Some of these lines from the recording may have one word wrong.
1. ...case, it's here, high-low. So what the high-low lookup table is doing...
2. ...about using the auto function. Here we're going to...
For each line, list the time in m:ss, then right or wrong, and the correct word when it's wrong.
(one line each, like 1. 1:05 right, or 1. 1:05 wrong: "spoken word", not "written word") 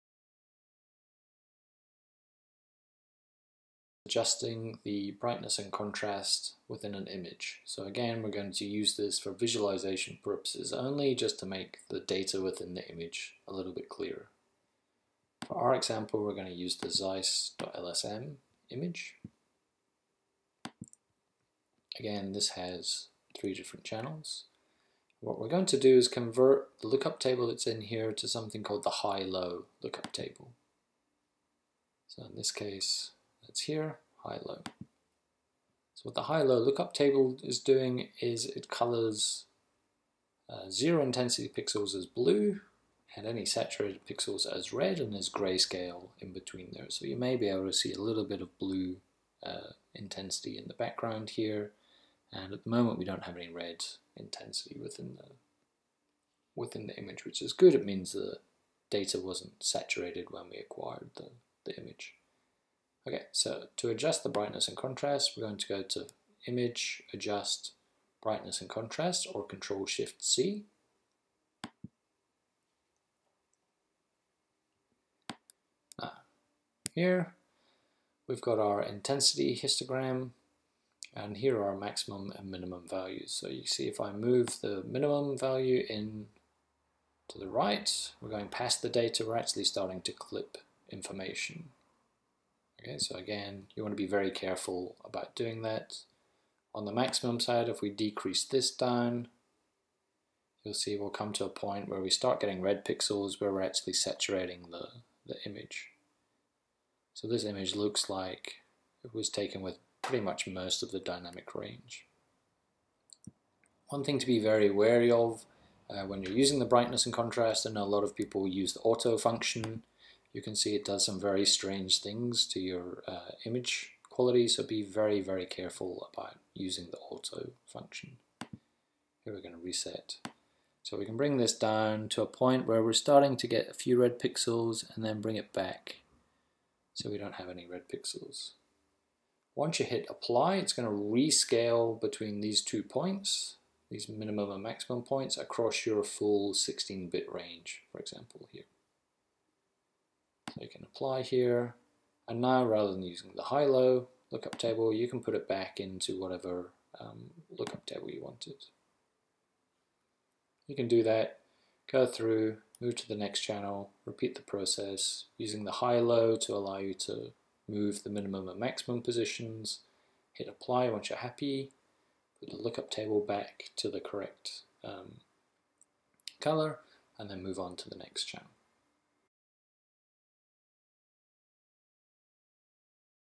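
1. 0:32 right
2. 2:06 right.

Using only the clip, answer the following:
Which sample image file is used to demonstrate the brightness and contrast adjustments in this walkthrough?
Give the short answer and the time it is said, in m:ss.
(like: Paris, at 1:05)
zeiss.lsm, at 0:16.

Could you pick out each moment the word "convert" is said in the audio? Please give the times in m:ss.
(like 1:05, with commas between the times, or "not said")
0:26.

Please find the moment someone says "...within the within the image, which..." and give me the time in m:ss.
0:54.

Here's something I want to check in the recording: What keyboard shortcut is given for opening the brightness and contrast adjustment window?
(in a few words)
Control Shift C.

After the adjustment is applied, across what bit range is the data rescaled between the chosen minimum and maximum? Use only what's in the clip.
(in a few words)
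16-bit.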